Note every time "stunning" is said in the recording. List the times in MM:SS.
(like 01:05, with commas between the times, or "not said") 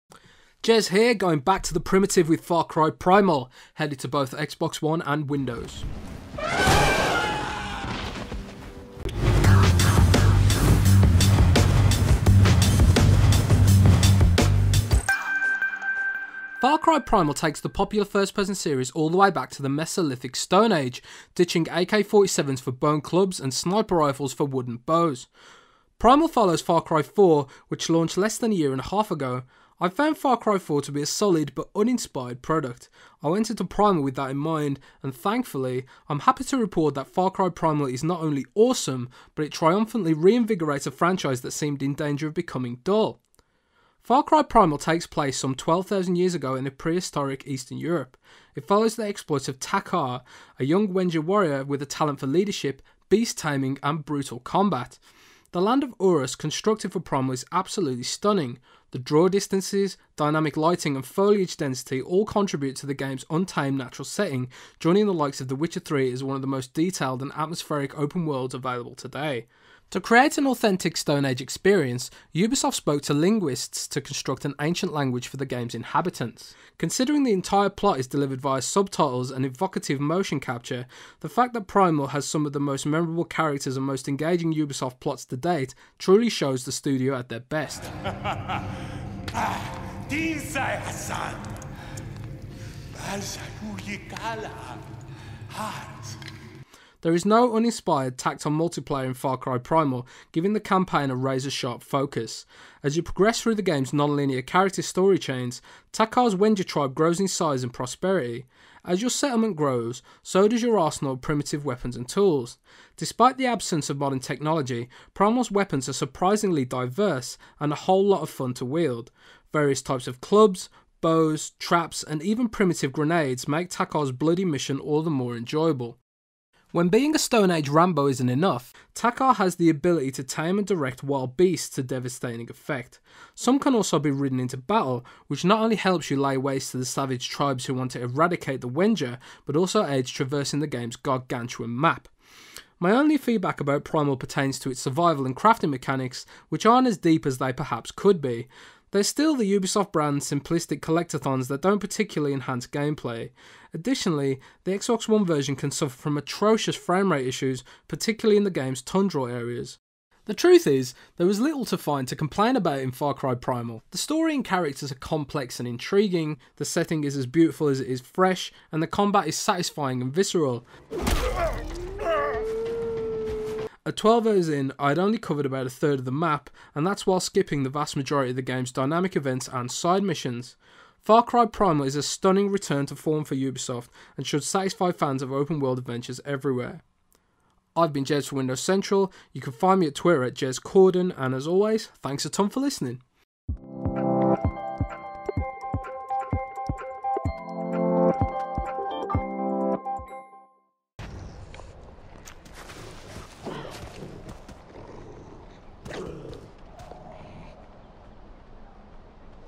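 00:58, 03:02.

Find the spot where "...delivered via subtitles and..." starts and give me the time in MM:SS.
01:18.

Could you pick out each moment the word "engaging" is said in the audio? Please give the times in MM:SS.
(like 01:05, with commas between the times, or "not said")
01:24.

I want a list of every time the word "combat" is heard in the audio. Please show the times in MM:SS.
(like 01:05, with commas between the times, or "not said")
00:54, 02:48.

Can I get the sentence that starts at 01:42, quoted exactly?
As you progress through the game's non-linear character story chains, Takkar's Wenja tribe grows in size and prosperity.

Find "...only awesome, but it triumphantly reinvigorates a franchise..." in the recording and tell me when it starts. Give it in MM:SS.
00:38.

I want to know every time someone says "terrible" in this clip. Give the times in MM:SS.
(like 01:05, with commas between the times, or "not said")
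not said.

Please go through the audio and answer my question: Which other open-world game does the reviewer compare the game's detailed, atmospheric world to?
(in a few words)
The Witcher 3.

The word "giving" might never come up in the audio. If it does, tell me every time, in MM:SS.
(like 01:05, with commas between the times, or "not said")
01:40.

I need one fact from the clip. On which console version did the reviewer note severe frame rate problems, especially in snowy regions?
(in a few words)
Xbox One.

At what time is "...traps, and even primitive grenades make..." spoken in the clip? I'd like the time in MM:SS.
02:01.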